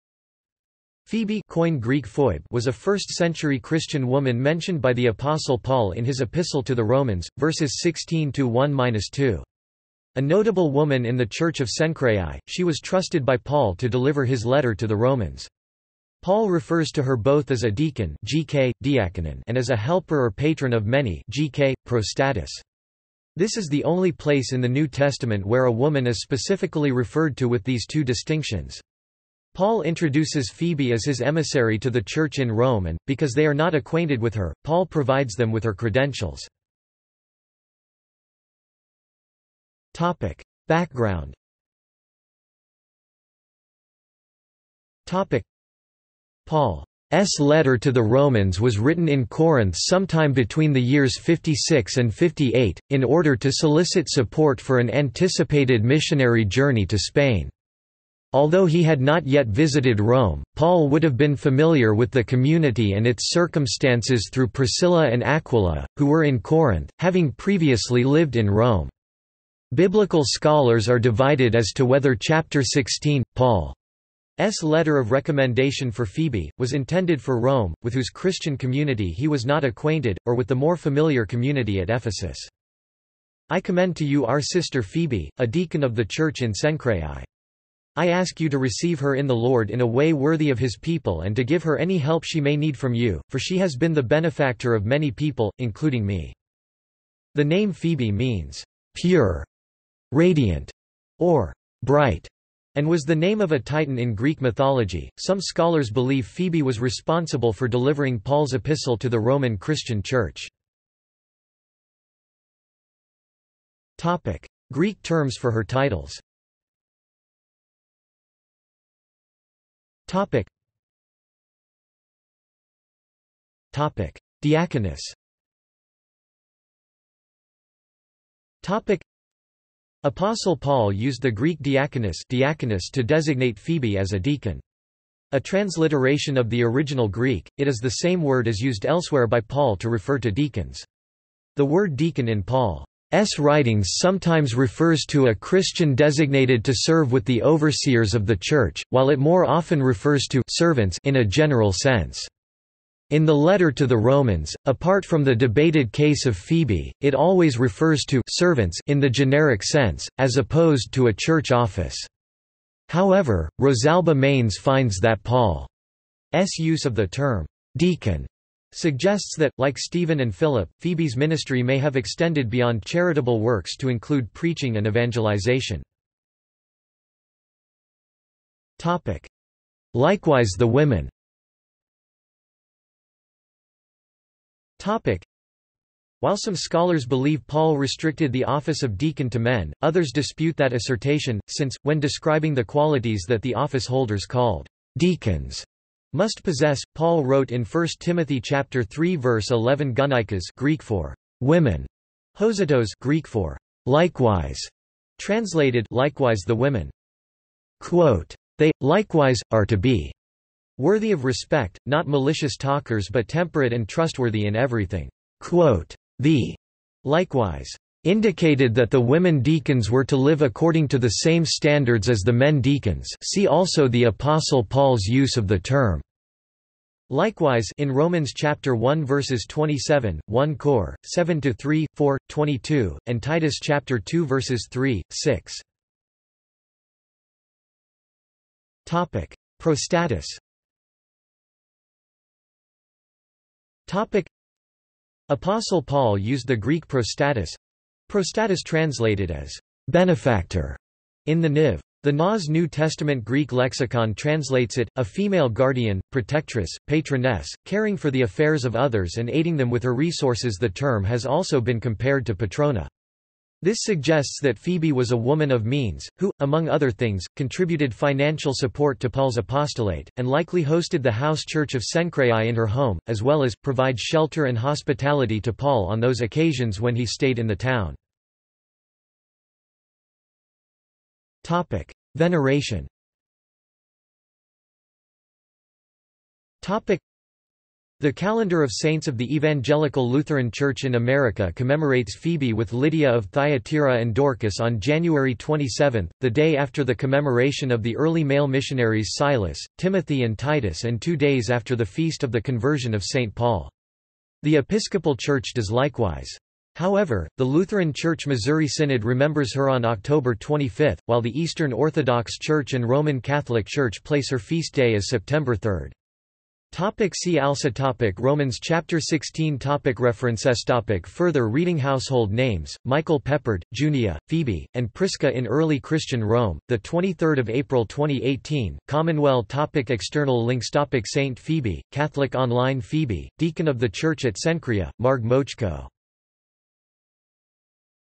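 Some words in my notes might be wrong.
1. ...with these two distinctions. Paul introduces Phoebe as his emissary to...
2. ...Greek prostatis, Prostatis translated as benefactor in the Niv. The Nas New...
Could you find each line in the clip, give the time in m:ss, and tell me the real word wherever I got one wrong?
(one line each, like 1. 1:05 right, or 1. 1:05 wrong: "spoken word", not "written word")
1. 0:27 right
2. 4:06 right.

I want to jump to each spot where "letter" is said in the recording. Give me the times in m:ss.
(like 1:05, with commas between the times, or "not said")
0:14, 0:47, 1:14, 2:33.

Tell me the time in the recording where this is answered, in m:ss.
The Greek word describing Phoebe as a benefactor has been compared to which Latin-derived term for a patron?
4:22.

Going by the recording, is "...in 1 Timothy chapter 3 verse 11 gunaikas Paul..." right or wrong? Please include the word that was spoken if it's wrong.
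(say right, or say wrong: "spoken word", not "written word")
wrong: "Greek", not "Paul".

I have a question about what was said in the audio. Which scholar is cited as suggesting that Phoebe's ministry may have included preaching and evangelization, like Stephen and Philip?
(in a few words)
Rosalba Manes.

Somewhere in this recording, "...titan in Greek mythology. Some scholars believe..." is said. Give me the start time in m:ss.
1:43.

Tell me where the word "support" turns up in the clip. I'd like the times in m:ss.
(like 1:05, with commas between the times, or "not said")
0:54, 4:28.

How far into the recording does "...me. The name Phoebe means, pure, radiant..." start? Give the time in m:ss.
1:36.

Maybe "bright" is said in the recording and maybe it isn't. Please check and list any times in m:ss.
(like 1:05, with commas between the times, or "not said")
1:41.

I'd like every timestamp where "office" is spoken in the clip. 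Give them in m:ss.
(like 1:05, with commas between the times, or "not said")
2:41, 3:08, 3:13.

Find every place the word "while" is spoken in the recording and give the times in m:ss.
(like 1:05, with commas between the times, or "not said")
2:28, 3:06, 5:11.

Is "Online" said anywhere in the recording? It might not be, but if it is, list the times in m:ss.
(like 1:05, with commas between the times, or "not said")
5:32.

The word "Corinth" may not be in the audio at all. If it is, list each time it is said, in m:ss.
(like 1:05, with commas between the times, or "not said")
0:49, 1:06.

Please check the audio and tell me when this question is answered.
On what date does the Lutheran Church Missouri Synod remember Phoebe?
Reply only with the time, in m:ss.
5:09.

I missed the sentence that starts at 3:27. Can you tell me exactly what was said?
Quote, they, likewise, are to be worthy of respect, not malicious talkers but temperate and trustworthy in everything.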